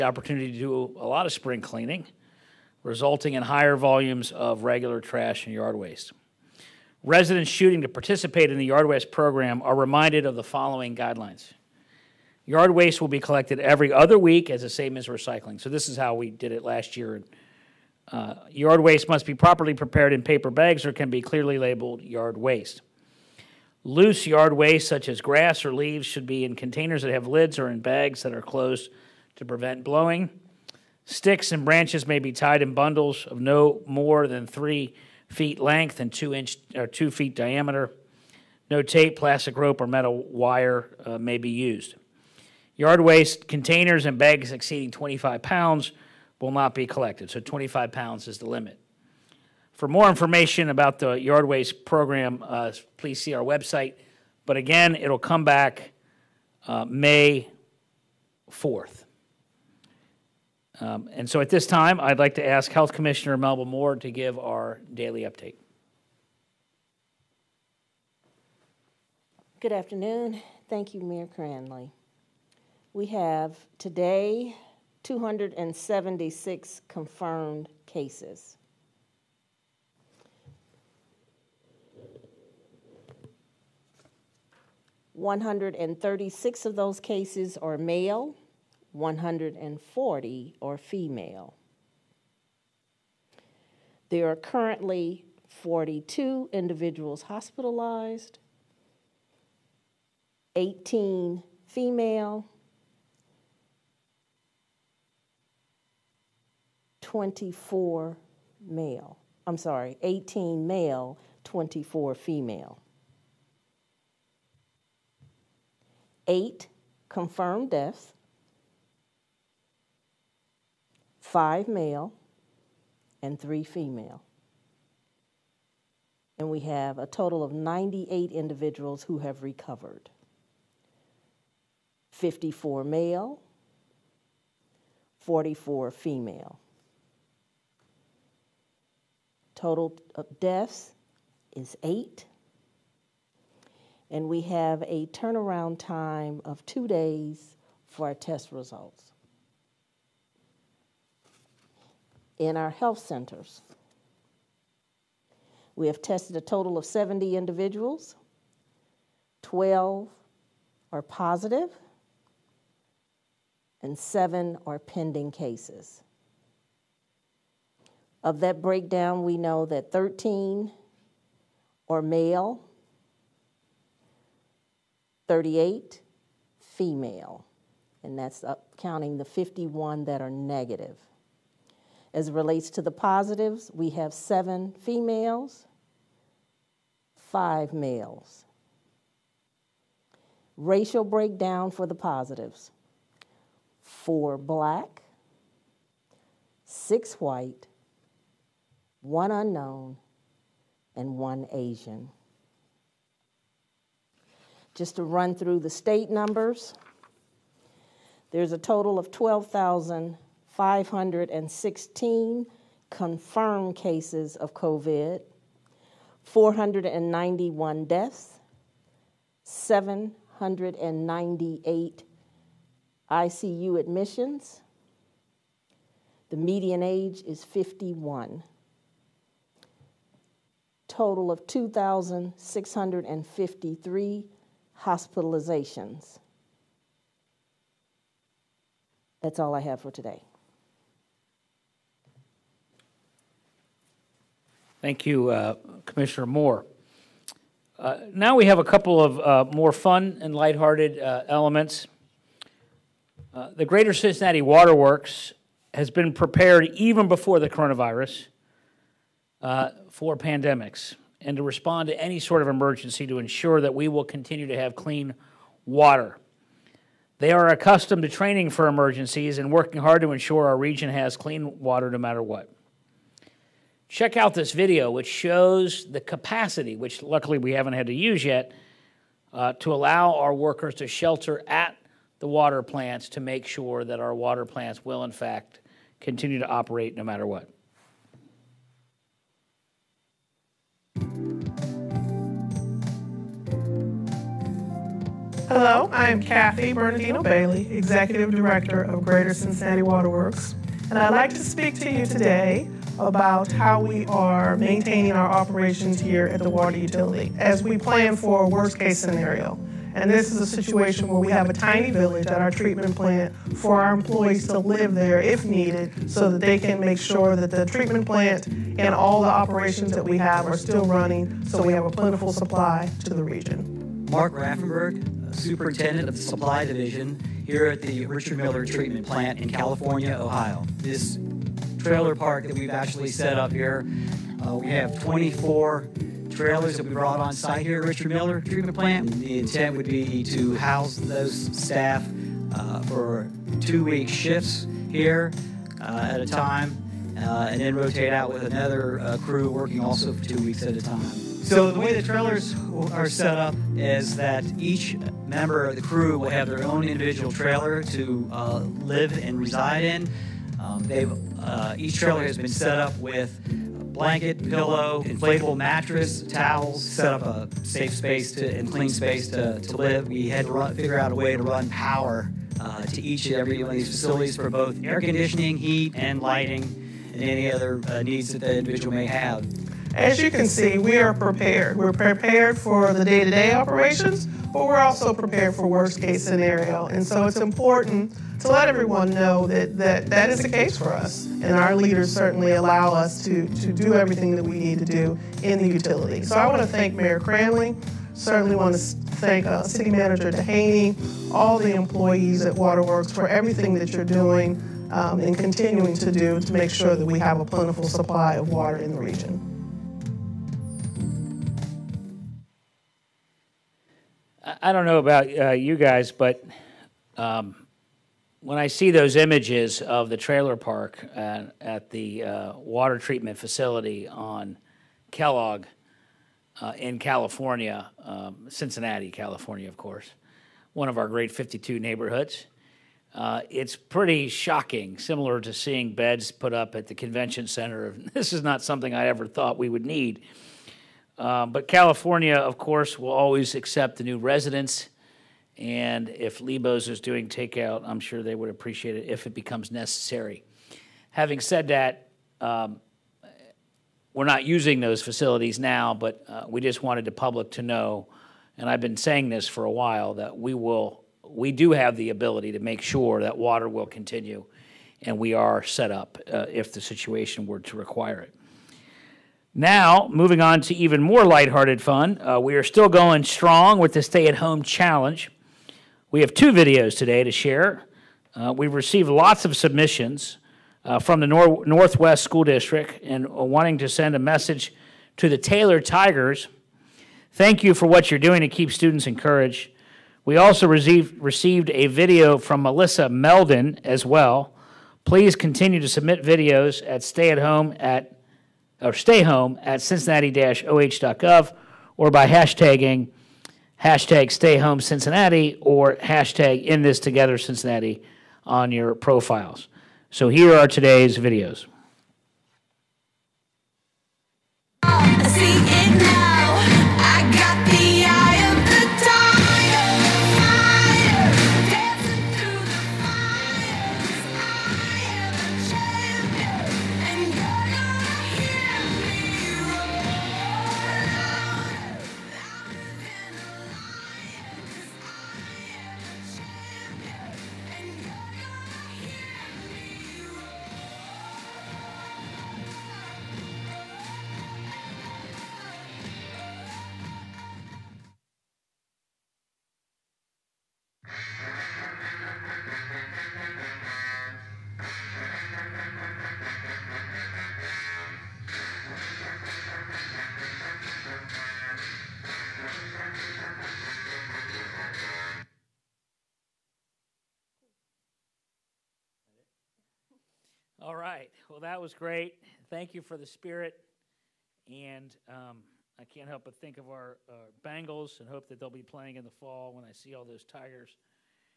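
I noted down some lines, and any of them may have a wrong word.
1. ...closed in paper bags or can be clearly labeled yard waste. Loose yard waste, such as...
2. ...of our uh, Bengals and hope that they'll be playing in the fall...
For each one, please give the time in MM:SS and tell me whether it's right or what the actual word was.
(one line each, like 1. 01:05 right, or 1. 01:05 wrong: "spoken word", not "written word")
1. 00:19 wrong: "prepared", not "closed"
2. 09:36 right.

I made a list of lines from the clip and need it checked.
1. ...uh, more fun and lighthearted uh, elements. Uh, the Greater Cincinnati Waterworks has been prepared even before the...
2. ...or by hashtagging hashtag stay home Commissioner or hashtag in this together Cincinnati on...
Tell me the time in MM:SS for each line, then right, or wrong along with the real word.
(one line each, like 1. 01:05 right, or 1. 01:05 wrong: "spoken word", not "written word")
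1. 04:09 right
2. 08:21 wrong: "Cincinnati", not "Commissioner".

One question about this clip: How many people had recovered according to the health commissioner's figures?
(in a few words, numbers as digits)
98.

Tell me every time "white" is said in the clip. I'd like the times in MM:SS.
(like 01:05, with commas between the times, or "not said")
03:17.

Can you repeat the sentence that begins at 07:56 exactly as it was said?
We have two videos today to share.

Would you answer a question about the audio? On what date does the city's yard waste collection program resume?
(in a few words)
May 4th.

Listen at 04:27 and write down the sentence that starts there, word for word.
They are accustomed to training for emergencies and working hard to ensure our region has clean water no matter what.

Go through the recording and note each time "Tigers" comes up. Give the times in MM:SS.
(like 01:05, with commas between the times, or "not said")
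08:05, 09:40.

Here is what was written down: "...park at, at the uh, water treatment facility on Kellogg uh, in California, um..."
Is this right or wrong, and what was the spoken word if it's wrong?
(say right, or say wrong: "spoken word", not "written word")
right.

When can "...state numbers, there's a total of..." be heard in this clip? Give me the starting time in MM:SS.
03:25.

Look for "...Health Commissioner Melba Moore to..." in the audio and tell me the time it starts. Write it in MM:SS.
01:02.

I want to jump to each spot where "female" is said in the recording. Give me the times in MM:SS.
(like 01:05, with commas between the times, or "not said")
01:30, 01:41, 01:52, 02:03, 02:15, 02:56, 03:04.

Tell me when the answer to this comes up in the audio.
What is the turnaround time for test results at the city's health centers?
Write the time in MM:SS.
02:26.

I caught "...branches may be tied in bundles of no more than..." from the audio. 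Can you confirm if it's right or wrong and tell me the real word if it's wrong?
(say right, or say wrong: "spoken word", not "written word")
right.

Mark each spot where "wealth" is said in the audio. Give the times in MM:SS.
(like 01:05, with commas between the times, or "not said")
not said.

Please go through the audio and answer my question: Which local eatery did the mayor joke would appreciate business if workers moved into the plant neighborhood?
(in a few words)
Lebo's.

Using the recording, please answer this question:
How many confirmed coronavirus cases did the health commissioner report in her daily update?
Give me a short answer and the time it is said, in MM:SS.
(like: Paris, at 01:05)
276, at 01:15.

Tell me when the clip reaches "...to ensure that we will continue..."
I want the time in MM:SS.
04:23.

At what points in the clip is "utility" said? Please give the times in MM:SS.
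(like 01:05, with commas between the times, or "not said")
05:06, 06:35.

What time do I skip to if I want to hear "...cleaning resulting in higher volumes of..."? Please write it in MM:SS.
00:01.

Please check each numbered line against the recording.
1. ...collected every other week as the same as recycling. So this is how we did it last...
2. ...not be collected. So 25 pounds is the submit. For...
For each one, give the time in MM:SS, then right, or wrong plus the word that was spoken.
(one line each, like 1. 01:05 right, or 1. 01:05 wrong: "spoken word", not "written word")
1. 00:13 right
2. 00:46 wrong: "limit", not "submit".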